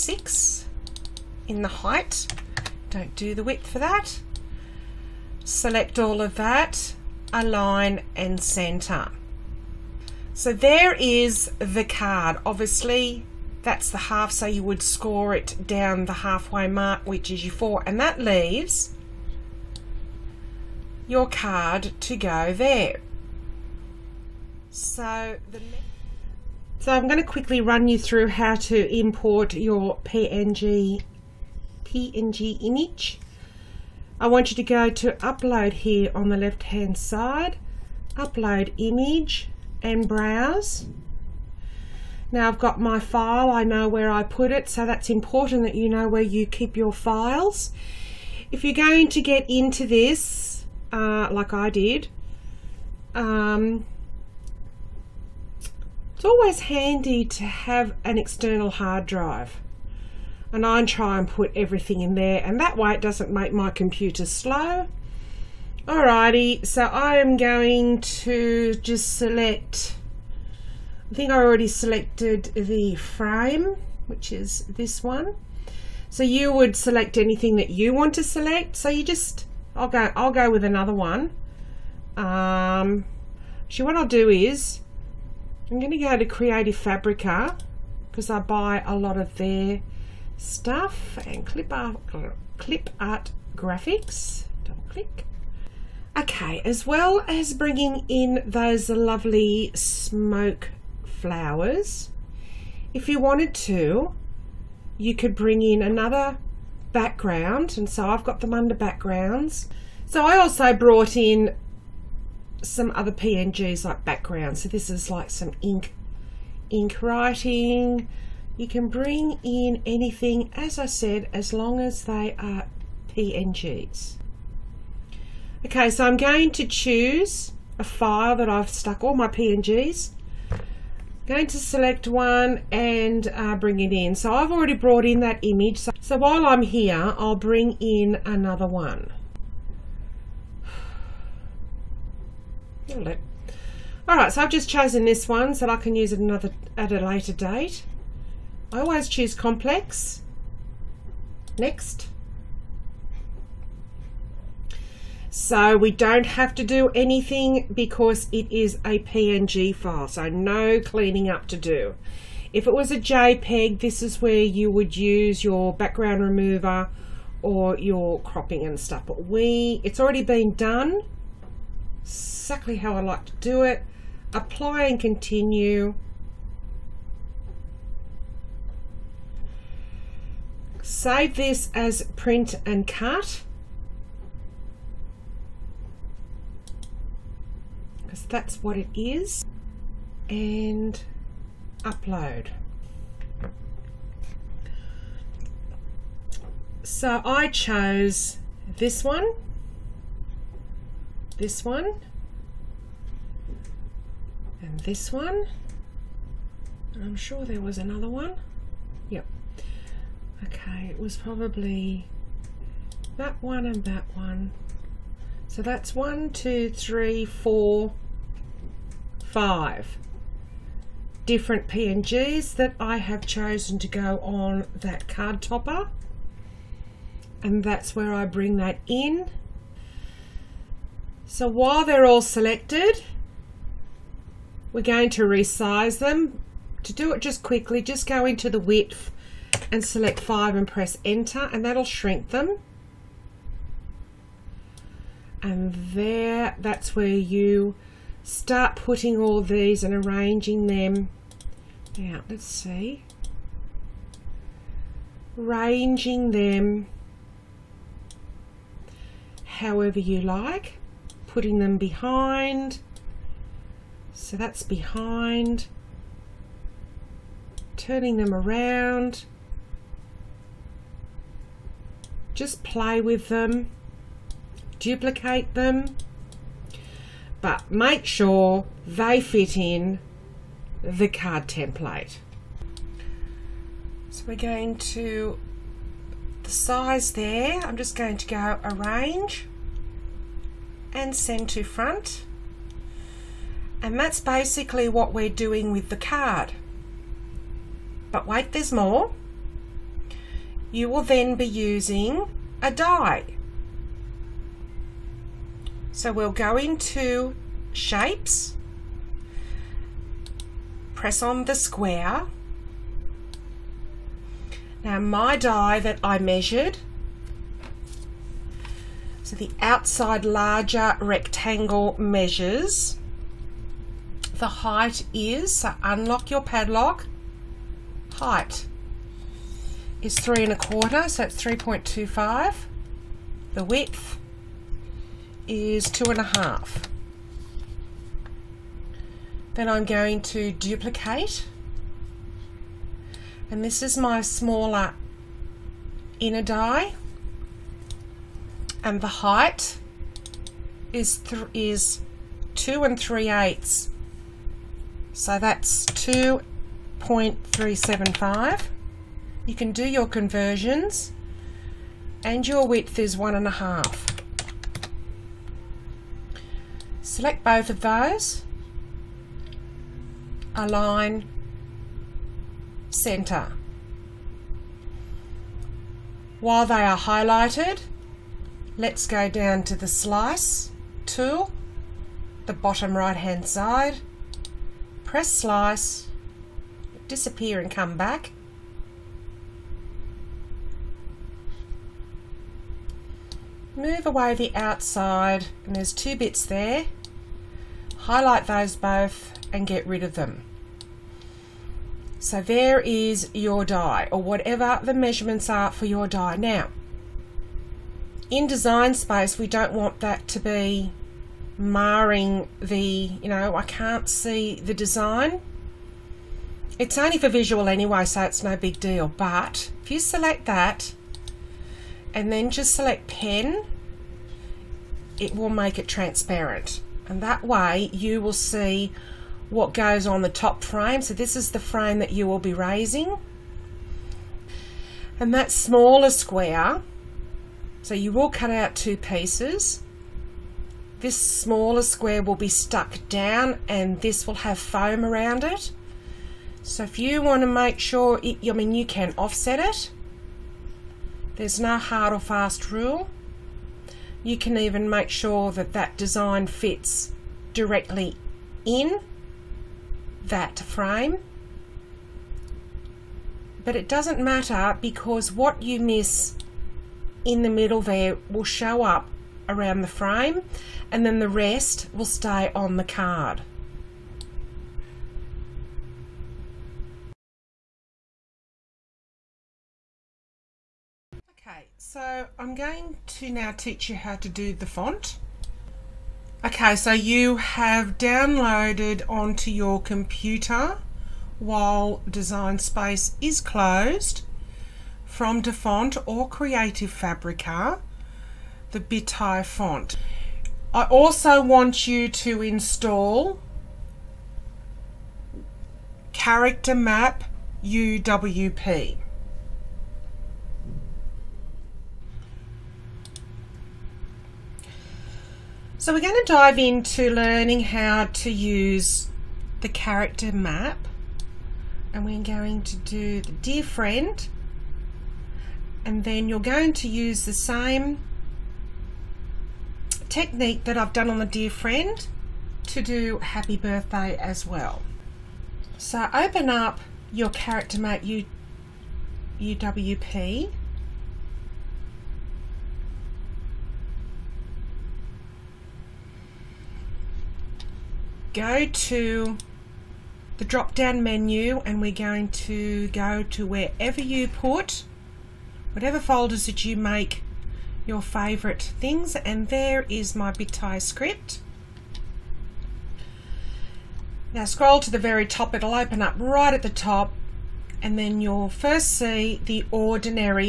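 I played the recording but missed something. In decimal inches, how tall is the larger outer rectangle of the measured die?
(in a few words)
3.25.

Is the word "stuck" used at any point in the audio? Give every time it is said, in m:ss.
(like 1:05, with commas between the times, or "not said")
2:08, 7:22.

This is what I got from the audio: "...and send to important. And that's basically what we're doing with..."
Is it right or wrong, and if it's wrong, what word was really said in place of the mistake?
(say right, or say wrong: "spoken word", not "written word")
wrong: "front", not "important".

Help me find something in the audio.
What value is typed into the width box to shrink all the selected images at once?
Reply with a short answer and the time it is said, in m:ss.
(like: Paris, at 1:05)
5, at 4:00.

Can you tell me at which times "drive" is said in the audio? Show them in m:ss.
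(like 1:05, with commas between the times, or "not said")
0:59.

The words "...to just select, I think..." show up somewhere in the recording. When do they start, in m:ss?
1:08.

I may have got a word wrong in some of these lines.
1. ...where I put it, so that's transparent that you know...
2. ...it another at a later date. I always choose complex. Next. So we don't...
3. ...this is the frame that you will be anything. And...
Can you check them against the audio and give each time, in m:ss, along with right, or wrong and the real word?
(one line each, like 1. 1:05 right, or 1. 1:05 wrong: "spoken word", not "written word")
1. 0:43 wrong: "important", not "transparent"
2. 2:26 right
3. 7:11 wrong: "raising", not "anything".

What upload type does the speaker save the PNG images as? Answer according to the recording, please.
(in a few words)
Print and cut.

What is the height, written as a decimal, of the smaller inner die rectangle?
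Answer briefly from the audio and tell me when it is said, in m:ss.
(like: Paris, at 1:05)
2.375, at 5:55.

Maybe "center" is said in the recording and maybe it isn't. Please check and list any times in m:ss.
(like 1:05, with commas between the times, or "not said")
0:08, 6:12.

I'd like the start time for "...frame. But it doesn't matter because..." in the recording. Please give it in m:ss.
7:40.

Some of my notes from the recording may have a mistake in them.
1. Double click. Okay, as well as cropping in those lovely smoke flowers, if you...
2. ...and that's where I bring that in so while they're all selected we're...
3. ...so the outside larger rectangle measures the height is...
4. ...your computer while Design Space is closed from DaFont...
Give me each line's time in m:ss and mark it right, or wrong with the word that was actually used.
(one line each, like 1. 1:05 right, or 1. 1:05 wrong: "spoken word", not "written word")
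1. 1:34 wrong: "bringing", not "cropping"
2. 3:47 right
3. 5:19 right
4. 8:09 right.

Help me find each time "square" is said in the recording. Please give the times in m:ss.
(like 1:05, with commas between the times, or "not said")
5:11, 7:16, 7:21.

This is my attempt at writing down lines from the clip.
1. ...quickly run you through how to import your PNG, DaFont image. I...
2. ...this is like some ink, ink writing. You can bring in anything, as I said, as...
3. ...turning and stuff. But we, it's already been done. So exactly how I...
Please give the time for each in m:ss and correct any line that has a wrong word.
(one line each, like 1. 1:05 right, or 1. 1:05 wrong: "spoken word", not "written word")
1. 0:27 wrong: "PNG", not "DaFont"
2. 1:54 right
3. 2:48 wrong: "cropping", not "turning".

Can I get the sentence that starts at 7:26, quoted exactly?
So if you want to make sure, it, I mean you can offset it.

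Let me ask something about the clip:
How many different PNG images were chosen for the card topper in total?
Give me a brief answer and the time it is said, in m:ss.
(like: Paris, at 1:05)
5, at 3:39.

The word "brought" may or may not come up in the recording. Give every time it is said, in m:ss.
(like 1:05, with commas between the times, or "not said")
1:50, 2:14.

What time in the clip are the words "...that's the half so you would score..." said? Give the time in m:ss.
0:13.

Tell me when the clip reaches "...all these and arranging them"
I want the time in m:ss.
4:09.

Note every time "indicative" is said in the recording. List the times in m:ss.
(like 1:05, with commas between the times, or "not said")
not said.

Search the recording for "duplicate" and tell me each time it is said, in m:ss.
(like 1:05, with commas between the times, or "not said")
4:34, 5:40.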